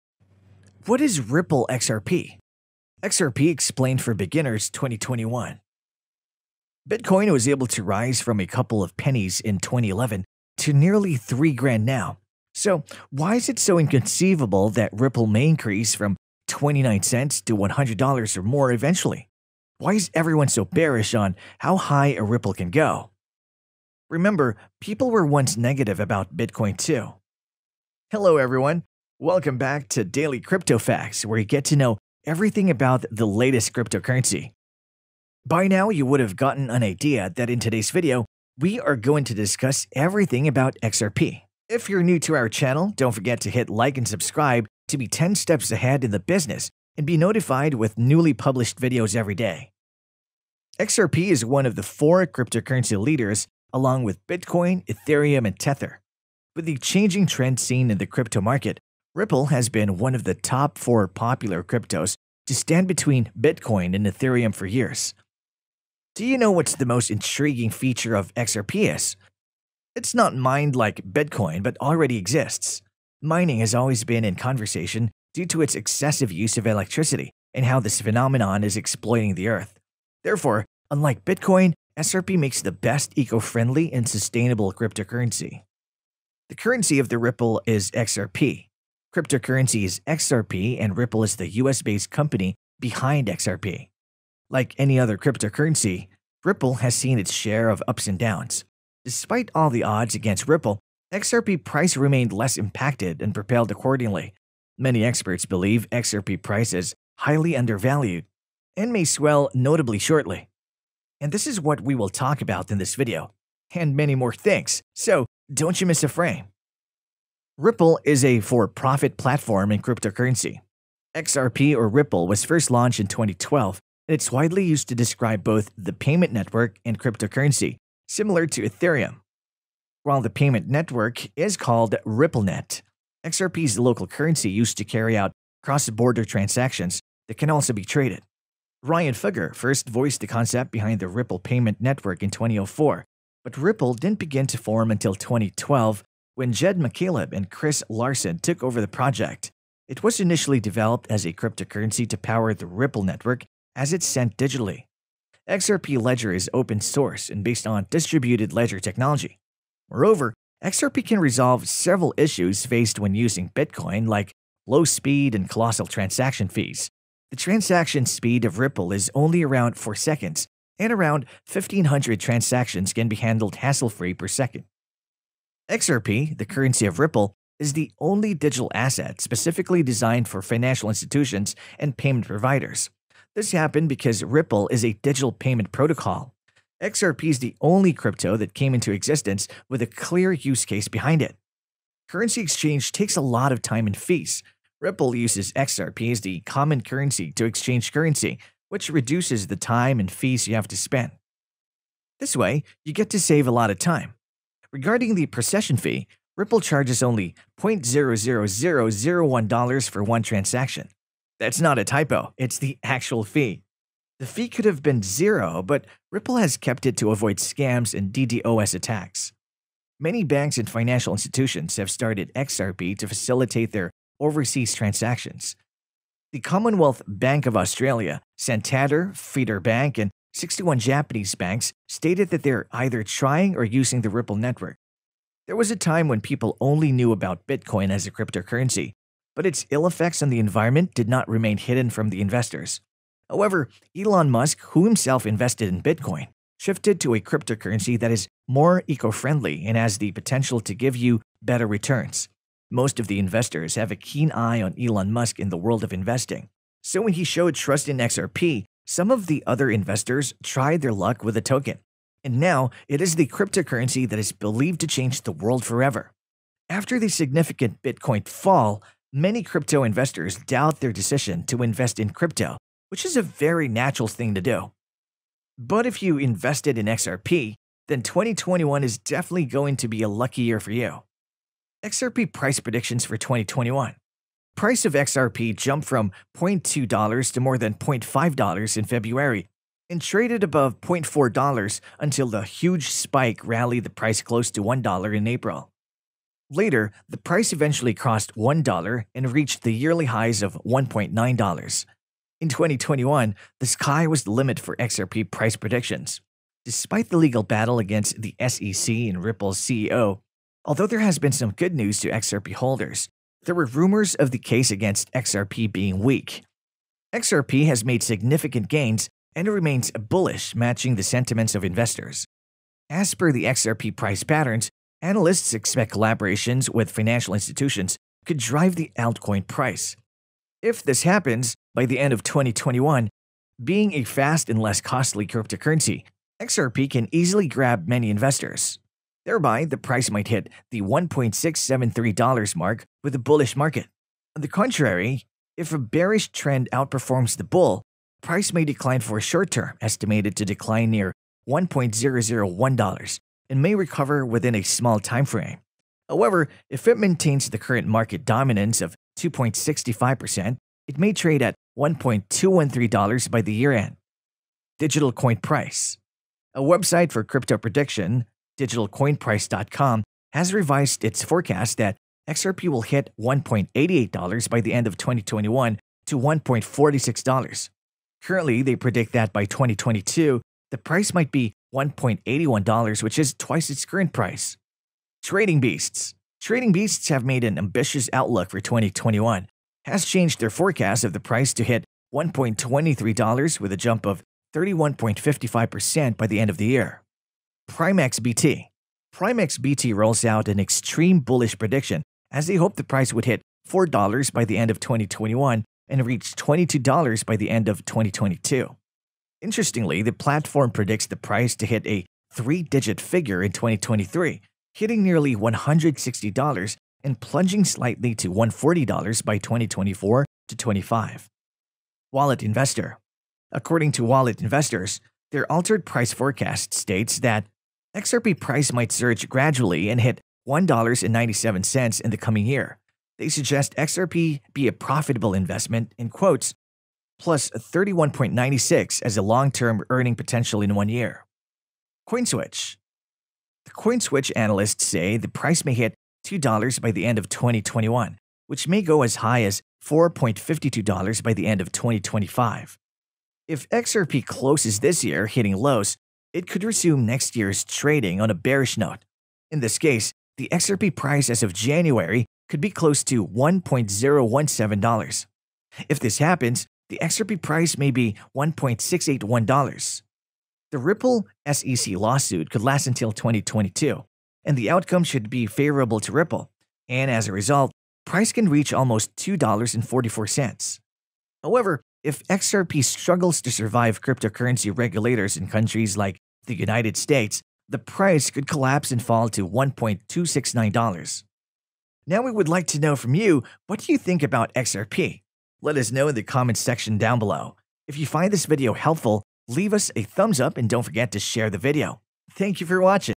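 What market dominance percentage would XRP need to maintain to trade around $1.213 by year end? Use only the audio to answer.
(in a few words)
2.65%.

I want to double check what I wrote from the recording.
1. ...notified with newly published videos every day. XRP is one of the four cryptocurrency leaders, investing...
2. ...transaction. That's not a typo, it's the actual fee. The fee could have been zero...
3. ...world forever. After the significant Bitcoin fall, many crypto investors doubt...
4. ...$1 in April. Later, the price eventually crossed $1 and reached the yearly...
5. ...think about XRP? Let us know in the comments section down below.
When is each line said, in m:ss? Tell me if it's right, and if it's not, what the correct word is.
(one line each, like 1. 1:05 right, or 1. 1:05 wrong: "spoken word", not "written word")
1. 0:47 wrong: "along", not "investing"
2. 3:30 right
3. 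4:25 right
4. 4:54 right
5. 8:13 right.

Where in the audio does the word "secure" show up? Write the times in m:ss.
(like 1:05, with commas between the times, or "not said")
not said.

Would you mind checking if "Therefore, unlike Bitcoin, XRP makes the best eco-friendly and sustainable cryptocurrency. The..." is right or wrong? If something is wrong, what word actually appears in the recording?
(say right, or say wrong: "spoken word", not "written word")
right.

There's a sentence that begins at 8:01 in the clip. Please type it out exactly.
However, if XRP struggles to survive cryptocurrency regulators in countries like the United States, the price could collapse and fall to $1.269.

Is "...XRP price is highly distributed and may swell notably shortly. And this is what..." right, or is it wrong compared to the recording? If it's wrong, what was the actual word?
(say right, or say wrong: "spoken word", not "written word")
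wrong: "undervalued", not "distributed".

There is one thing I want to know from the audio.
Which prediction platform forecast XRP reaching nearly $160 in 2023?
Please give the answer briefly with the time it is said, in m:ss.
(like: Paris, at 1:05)
PrimeXBT, at 6:37.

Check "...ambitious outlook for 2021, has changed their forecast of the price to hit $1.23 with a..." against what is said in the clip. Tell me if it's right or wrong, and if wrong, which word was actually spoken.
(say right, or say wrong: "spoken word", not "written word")
right.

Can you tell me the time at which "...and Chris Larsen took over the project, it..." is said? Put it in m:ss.
2:27.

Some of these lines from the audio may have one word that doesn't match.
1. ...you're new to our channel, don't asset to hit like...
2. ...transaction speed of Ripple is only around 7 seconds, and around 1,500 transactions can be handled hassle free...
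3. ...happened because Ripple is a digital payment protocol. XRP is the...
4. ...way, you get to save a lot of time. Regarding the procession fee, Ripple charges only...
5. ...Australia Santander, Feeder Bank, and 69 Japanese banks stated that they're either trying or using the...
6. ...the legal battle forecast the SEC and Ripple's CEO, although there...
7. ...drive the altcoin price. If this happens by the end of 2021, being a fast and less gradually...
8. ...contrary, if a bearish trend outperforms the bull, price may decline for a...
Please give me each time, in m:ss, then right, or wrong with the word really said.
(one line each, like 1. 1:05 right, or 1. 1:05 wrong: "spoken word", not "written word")
1. 0:41 wrong: "forget", not "asset"
2. 2:47 wrong: "4", not "7"
3. 3:03 right
4. 3:22 right
5. 3:47 wrong: "61", not "69"
6. 5:07 wrong: "against", not "forecast"
7. 5:28 wrong: "costly", not "gradually"
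8. 5:44 right.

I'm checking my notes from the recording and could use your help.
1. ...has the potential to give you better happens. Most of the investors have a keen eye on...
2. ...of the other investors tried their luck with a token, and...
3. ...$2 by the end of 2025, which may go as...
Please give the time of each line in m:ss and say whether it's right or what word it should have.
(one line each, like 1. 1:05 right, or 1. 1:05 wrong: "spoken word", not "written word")
1. 4:09 wrong: "returns", not "happens"
2. 4:19 right
3. 7:26 wrong: "2021", not "2025".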